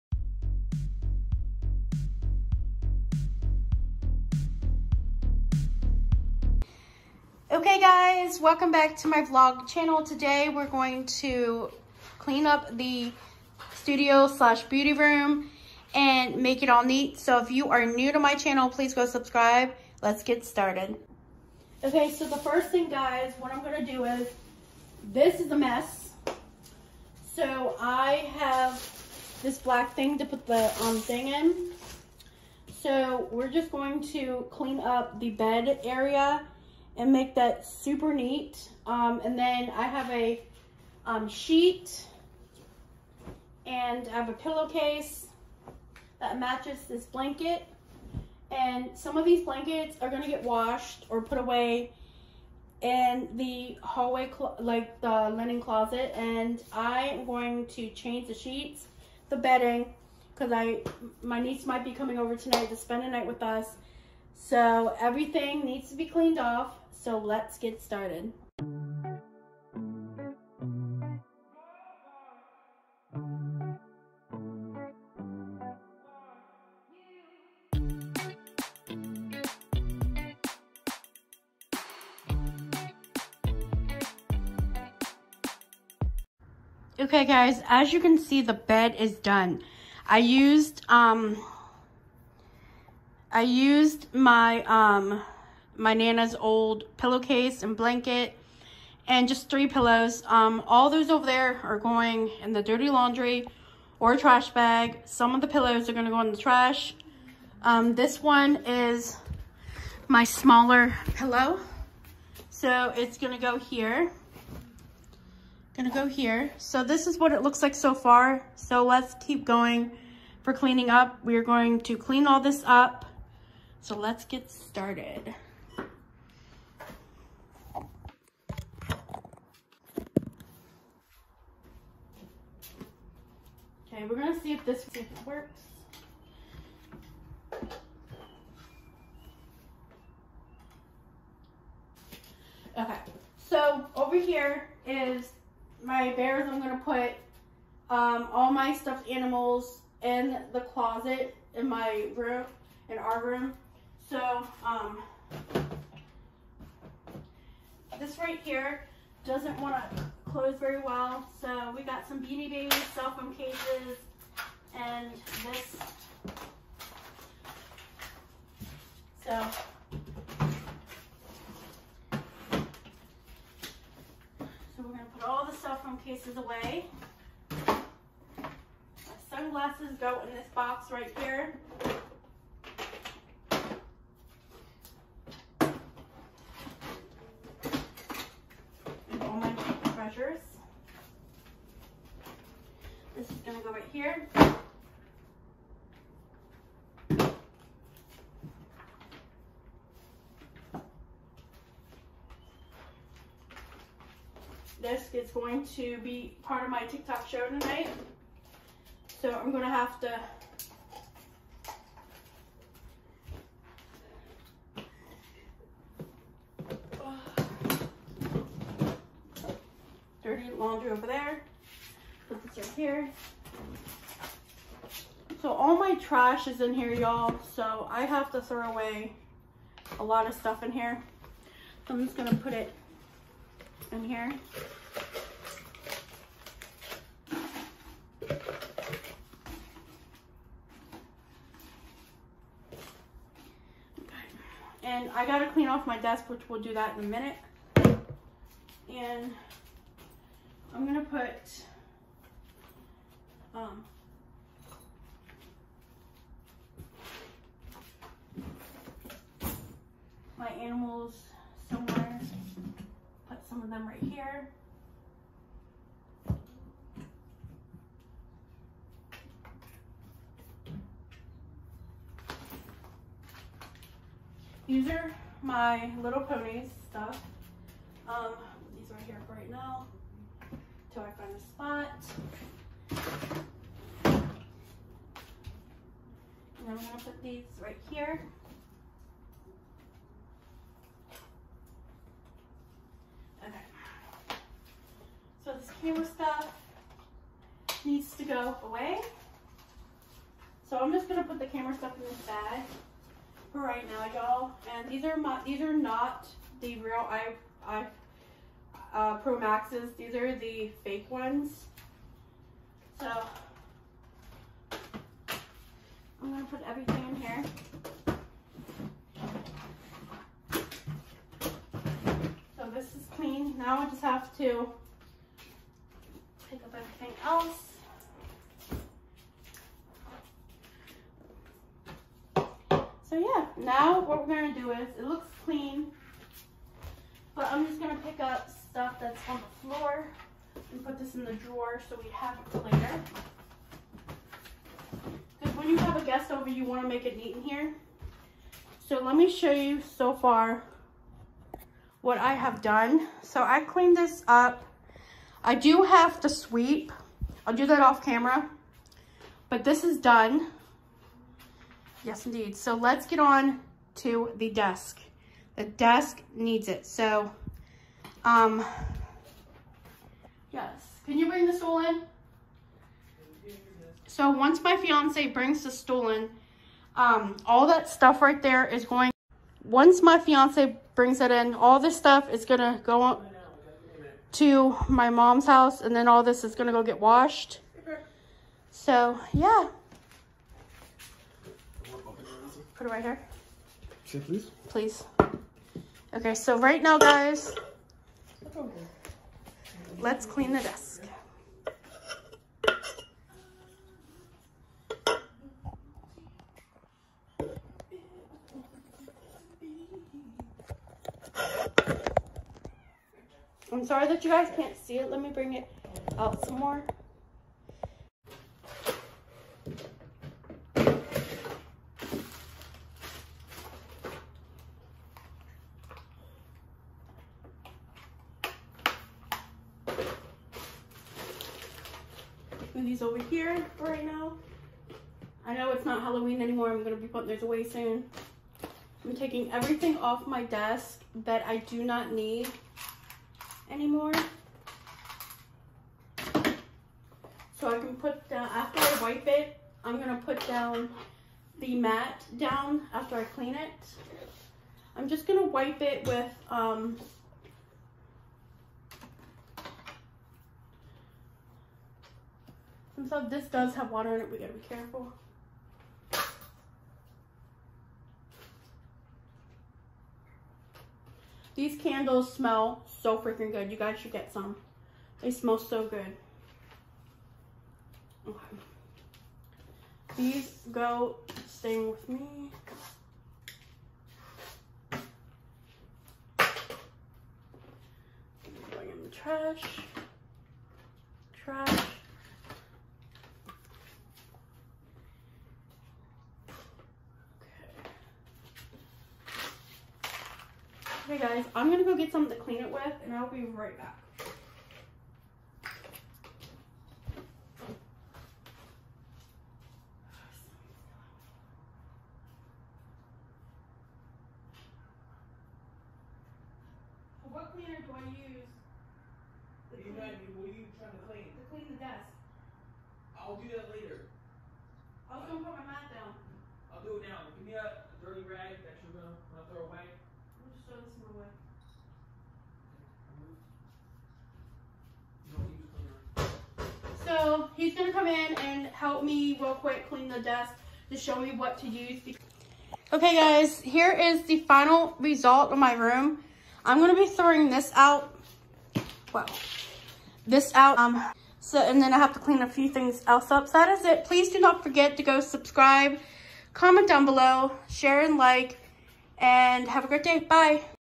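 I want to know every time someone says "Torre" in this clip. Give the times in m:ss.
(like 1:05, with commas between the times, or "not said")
not said.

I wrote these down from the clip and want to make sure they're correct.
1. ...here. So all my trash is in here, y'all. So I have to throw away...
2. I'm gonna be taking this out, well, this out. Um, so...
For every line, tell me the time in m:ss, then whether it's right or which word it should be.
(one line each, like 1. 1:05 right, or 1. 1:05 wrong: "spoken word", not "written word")
1. 3:42 right
2. 9:06 wrong: "throwing", not "taking".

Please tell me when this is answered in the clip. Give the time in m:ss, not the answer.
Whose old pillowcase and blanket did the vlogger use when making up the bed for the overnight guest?
1:35.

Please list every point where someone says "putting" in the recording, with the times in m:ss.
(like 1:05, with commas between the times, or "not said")
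7:17.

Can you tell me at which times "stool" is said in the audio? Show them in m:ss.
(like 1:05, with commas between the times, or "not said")
6:11, 6:15.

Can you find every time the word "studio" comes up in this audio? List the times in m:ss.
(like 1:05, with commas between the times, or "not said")
0:13.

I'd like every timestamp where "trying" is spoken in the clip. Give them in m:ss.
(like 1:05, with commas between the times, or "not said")
8:40.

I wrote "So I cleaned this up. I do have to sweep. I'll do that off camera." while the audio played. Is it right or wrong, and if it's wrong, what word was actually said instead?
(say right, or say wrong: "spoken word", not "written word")
right.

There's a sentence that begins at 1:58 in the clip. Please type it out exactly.
So let's keep going for cleaning up.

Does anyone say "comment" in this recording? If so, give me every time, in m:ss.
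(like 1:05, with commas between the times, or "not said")
9:16.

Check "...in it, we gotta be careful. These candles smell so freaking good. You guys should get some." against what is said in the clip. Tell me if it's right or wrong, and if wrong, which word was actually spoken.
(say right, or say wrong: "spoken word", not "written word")
right.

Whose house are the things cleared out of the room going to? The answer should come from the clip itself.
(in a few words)
Mom's house.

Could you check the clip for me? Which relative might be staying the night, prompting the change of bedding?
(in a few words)
Niece.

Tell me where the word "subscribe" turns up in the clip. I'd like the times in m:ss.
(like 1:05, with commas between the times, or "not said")
0:19, 9:15.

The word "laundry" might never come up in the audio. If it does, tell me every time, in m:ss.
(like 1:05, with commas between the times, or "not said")
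1:42, 3:40.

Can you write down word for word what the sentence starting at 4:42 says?
And then I'm gonna put these right here.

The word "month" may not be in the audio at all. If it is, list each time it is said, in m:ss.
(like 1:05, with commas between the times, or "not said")
not said.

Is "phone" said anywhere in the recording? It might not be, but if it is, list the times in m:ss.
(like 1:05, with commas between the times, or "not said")
2:43, 2:55.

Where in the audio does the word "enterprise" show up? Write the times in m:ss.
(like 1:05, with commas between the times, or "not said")
not said.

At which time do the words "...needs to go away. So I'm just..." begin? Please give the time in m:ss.
4:57.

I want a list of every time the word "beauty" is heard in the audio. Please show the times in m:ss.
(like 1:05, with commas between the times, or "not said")
0:14.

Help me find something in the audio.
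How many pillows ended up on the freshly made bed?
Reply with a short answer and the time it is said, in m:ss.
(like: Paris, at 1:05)
3, at 1:39.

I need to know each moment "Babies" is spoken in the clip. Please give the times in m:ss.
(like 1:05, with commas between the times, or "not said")
2:42.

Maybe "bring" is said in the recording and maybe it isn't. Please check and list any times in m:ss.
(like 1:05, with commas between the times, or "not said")
6:11, 6:15, 6:20, 6:55.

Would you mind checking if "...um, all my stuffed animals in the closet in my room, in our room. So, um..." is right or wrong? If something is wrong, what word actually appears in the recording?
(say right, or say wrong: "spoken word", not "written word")
right.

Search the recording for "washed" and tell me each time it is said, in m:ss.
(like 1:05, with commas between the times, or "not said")
0:50, 6:26.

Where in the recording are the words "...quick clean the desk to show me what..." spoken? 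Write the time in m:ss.
8:59.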